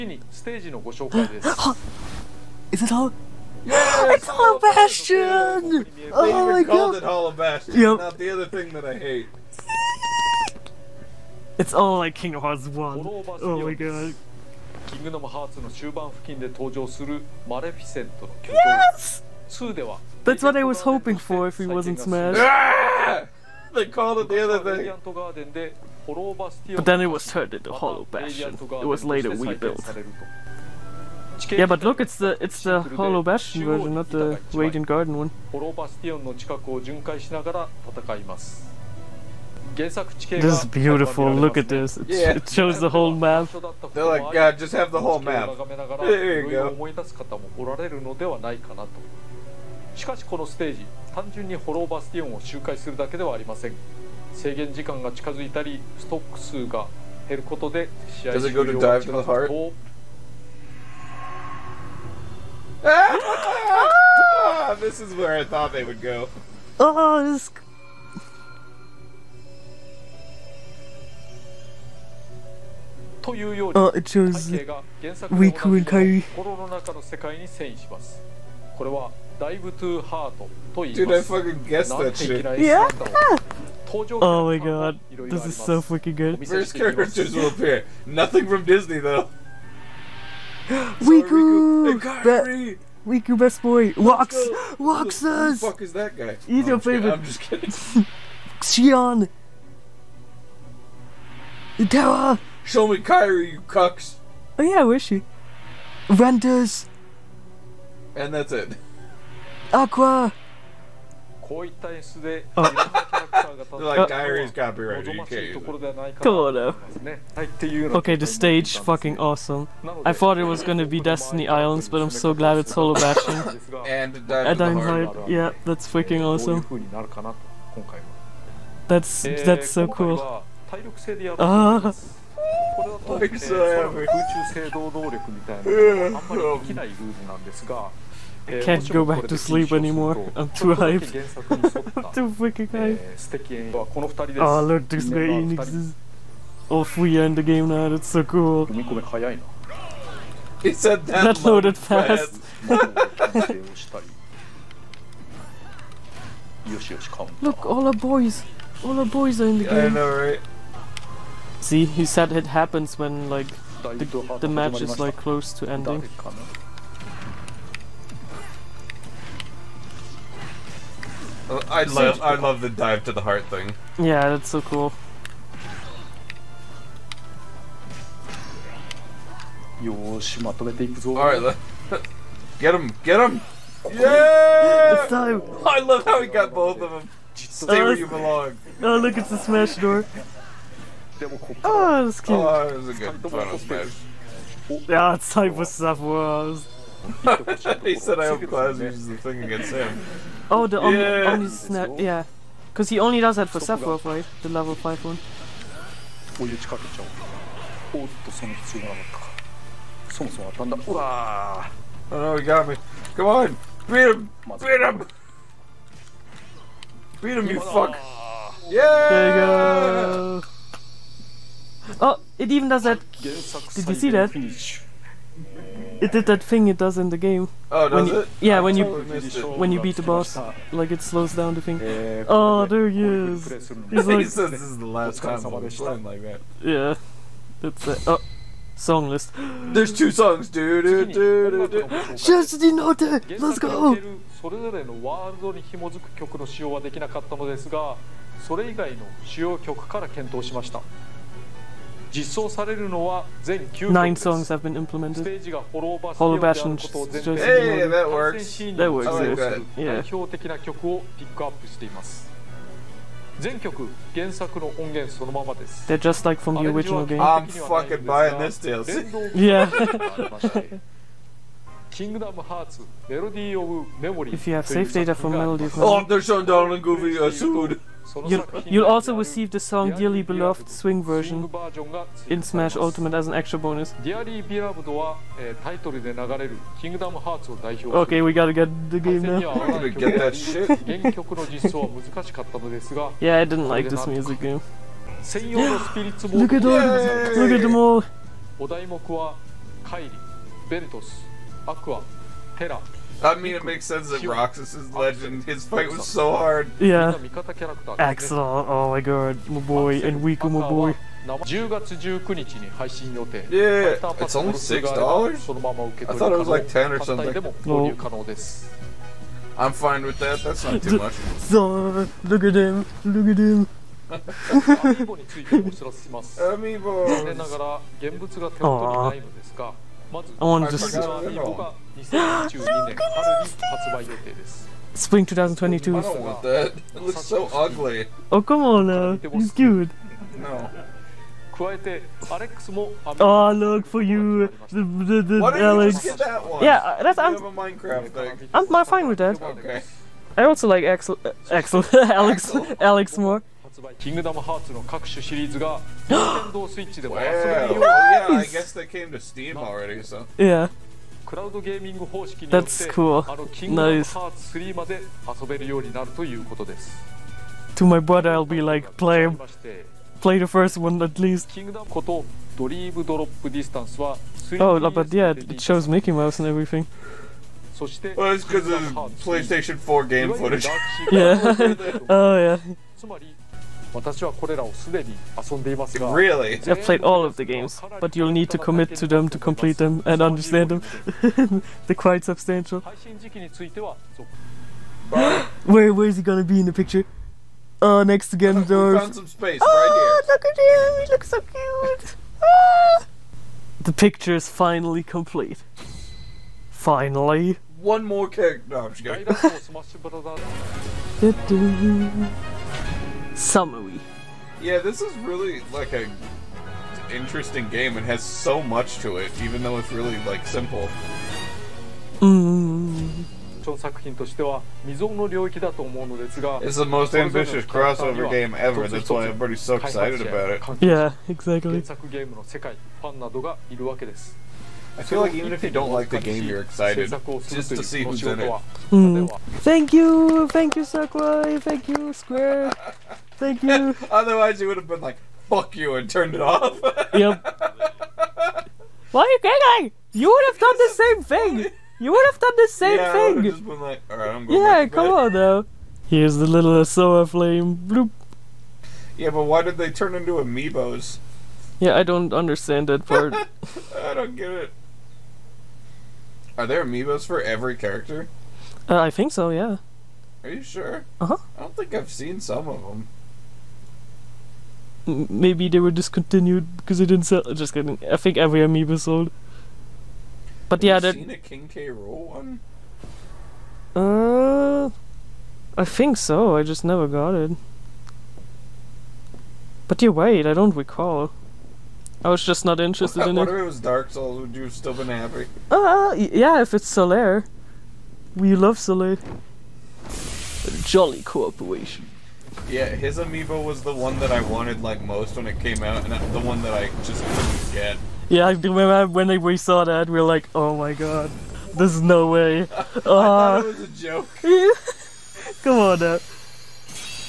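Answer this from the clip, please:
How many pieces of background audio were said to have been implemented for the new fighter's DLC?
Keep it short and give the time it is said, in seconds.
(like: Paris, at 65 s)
9, at 253 s.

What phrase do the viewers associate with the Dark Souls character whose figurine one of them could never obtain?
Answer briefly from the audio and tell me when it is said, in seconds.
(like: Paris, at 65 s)
Jolly cooperation, at 500 s.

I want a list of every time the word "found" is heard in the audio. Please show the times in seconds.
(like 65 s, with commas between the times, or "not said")
398 s.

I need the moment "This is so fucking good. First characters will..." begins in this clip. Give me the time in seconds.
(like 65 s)
85 s.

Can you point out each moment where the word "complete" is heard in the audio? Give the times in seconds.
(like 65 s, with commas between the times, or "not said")
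389 s, 405 s.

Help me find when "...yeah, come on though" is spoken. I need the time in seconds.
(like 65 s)
454 s.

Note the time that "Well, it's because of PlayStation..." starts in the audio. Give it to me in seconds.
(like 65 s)
378 s.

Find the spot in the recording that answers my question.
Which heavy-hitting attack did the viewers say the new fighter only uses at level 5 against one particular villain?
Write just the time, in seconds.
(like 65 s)
201 s.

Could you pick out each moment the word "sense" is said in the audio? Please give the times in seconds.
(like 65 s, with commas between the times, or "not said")
303 s.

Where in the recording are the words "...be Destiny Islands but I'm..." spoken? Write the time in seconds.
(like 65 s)
120 s.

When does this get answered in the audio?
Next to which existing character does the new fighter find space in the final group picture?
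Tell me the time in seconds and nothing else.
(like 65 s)
398 s.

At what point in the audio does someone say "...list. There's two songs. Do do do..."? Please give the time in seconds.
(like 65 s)
239 s.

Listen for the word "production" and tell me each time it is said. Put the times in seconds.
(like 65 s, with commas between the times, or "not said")
not said.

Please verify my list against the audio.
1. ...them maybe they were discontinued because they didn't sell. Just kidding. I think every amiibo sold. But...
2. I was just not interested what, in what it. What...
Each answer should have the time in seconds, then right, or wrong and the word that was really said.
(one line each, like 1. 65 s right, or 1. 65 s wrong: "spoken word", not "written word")
1. 472 s right
2. 492 s right.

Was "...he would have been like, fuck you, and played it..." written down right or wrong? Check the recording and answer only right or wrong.
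wrong.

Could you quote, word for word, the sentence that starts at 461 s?
Yeah, I don't understand that part.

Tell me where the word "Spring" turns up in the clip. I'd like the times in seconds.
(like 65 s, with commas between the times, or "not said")
334 s.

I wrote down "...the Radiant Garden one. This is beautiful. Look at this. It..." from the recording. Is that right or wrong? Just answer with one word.
right.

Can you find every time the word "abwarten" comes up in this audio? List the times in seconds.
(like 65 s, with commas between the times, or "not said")
195 s.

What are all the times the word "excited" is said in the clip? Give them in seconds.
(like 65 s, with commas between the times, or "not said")
429 s, 436 s.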